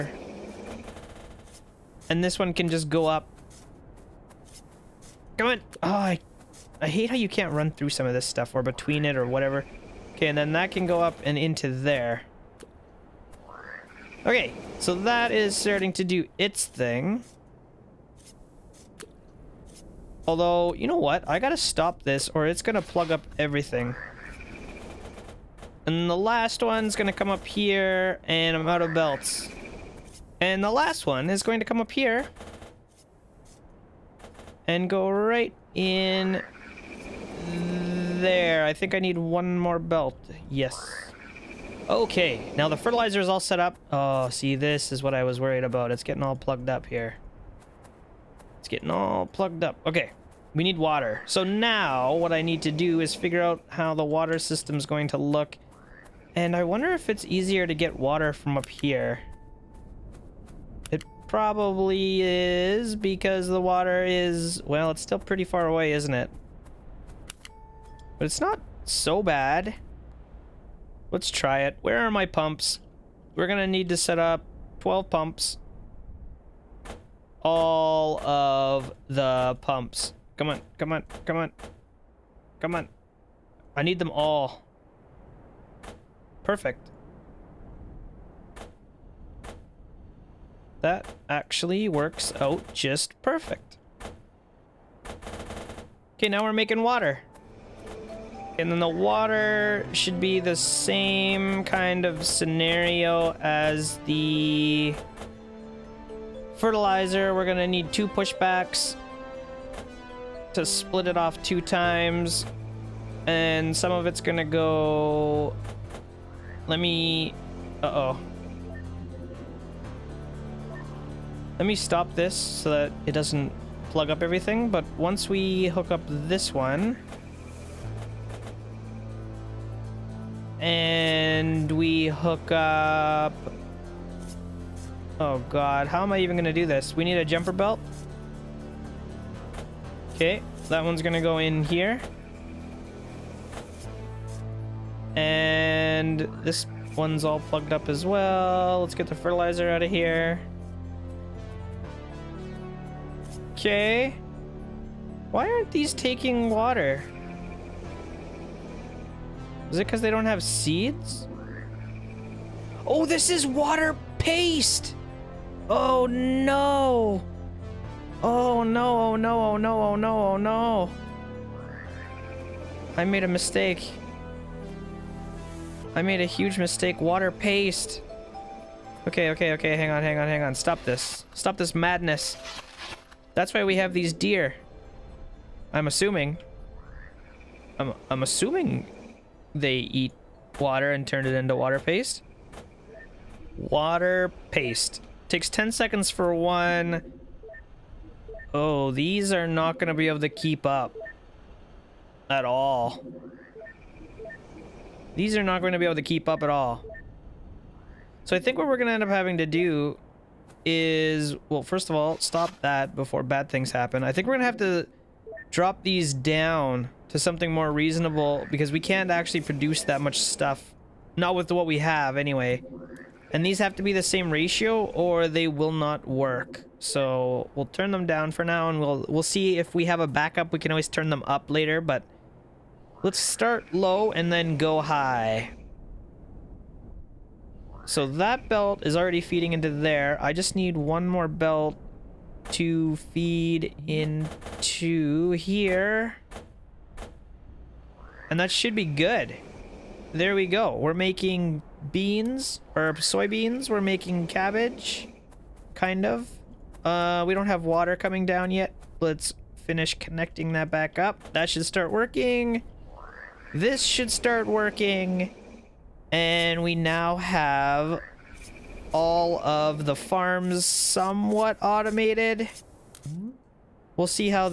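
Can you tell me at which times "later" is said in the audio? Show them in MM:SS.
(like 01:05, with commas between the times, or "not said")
03:51.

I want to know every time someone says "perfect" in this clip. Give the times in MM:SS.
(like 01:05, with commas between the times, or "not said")
01:26, 01:33.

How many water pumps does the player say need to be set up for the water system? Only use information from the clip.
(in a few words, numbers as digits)
12.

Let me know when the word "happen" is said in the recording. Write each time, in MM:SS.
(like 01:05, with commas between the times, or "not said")
03:33.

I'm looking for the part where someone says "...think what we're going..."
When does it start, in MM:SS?
03:28.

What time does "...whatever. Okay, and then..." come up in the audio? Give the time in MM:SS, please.
00:09.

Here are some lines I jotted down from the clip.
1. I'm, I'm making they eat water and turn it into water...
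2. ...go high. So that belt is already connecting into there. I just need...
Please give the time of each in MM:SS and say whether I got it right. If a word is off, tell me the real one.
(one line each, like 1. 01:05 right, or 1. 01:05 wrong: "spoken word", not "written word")
1. 03:07 wrong: "assuming", not "making"
2. 03:54 wrong: "feeding", not "connecting".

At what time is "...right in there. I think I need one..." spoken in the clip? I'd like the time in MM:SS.
00:35.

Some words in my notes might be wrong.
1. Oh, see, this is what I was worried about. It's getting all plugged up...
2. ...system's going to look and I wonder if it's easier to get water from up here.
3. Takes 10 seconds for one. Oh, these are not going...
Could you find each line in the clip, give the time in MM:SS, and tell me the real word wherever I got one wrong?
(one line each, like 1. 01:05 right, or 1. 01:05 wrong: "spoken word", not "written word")
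1. 00:43 right
2. 00:54 right
3. 03:15 right.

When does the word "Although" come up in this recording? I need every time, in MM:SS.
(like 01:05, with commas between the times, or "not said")
00:20.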